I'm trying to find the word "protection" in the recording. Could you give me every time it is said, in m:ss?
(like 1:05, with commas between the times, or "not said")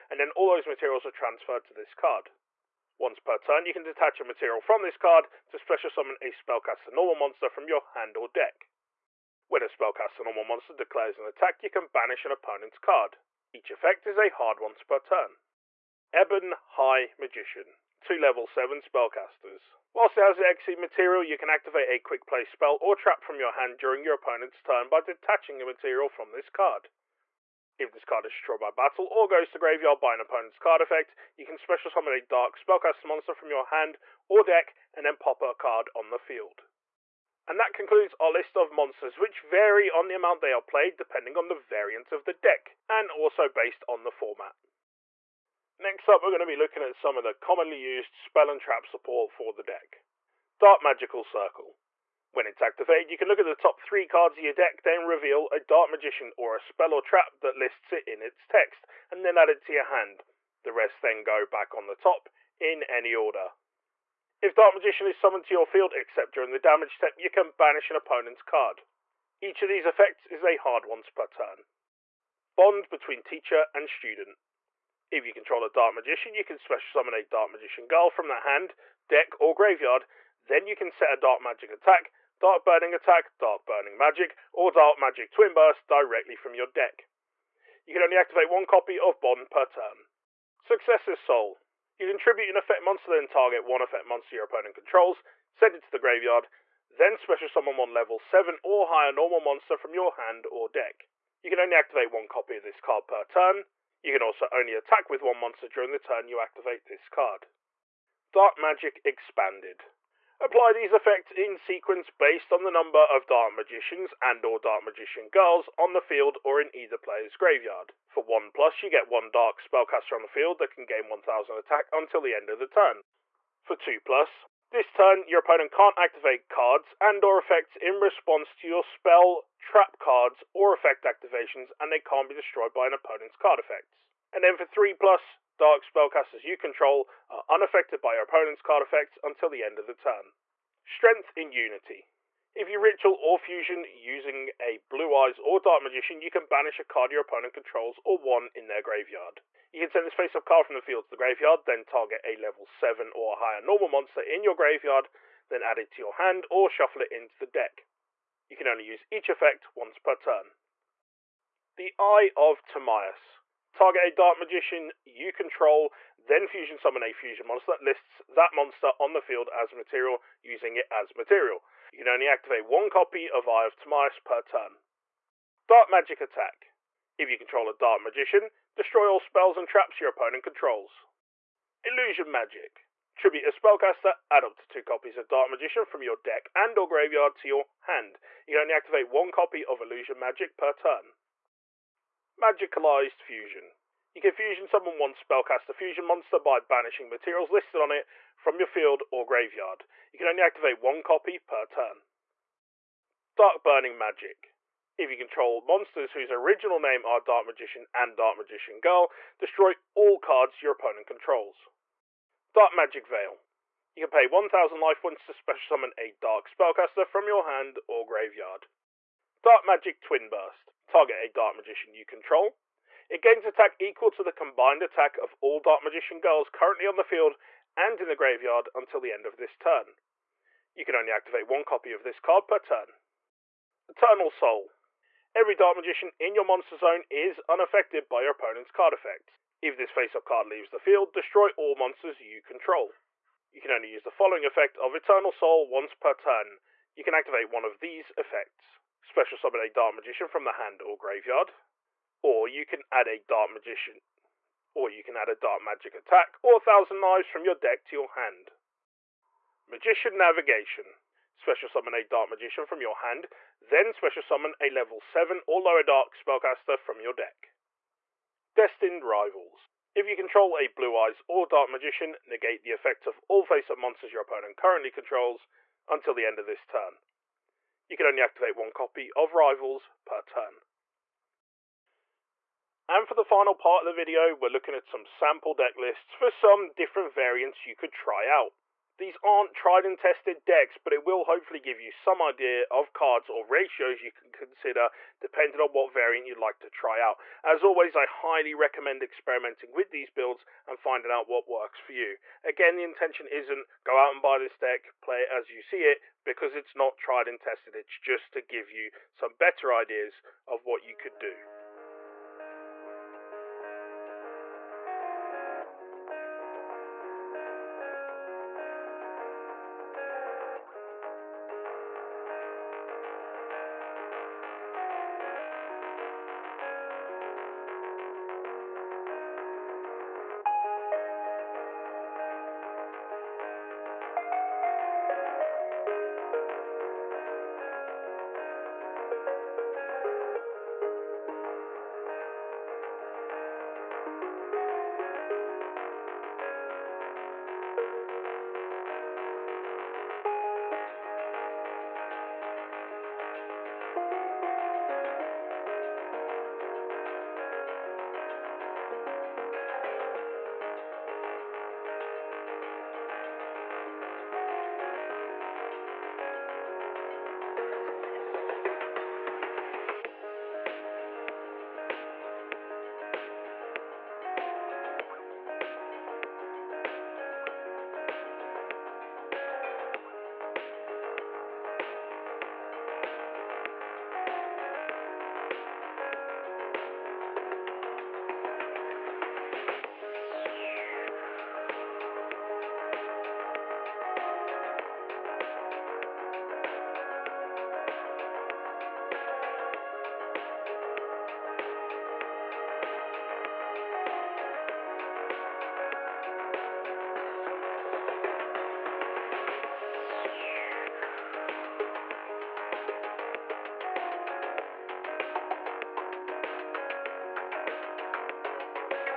not said.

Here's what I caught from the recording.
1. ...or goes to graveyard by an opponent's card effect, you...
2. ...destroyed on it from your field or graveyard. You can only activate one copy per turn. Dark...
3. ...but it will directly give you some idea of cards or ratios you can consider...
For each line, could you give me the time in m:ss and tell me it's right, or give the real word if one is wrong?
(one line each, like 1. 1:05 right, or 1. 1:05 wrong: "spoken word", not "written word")
1. 0:29 right
2. 3:17 wrong: "listed", not "destroyed"
3. 4:50 wrong: "hopefully", not "directly".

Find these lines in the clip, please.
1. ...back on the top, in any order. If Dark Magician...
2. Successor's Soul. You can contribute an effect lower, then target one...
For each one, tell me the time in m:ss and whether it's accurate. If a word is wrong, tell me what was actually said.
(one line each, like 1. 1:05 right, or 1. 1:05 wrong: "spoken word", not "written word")
1. 1:01 right
2. 1:30 wrong: "monster", not "lower".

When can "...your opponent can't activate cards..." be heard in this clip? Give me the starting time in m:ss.
2:05.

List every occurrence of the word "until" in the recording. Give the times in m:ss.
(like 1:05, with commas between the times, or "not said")
2:01, 2:19, 3:48, 4:35.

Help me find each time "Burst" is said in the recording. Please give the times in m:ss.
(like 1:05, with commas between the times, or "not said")
1:25, 3:40.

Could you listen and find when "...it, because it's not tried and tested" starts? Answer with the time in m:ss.
5:05.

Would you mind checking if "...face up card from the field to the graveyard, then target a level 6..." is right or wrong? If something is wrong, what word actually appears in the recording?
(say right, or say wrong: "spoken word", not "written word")
wrong: "7", not "6".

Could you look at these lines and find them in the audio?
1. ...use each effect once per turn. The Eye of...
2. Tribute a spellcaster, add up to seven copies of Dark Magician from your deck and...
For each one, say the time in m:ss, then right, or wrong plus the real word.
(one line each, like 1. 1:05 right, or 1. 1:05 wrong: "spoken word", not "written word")
1. 2:38 right
2. 3:03 wrong: "two", not "seven".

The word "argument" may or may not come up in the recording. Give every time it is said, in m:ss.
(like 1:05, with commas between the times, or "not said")
not said.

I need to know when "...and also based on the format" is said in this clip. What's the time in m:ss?
0:42.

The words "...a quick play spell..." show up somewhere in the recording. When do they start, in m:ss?
0:21.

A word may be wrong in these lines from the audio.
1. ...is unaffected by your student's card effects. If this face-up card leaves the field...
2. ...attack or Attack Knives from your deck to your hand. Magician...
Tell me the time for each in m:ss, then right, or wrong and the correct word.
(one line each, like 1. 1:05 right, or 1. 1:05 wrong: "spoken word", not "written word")
1. 3:57 wrong: "opponent", not "student"
2. 4:15 wrong: "Thousand", not "Attack".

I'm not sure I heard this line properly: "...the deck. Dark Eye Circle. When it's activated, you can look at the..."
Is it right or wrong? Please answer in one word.
wrong.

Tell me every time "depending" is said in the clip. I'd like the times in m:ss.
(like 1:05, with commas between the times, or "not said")
0:40, 4:55.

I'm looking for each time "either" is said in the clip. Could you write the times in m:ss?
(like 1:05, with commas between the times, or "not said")
1:56.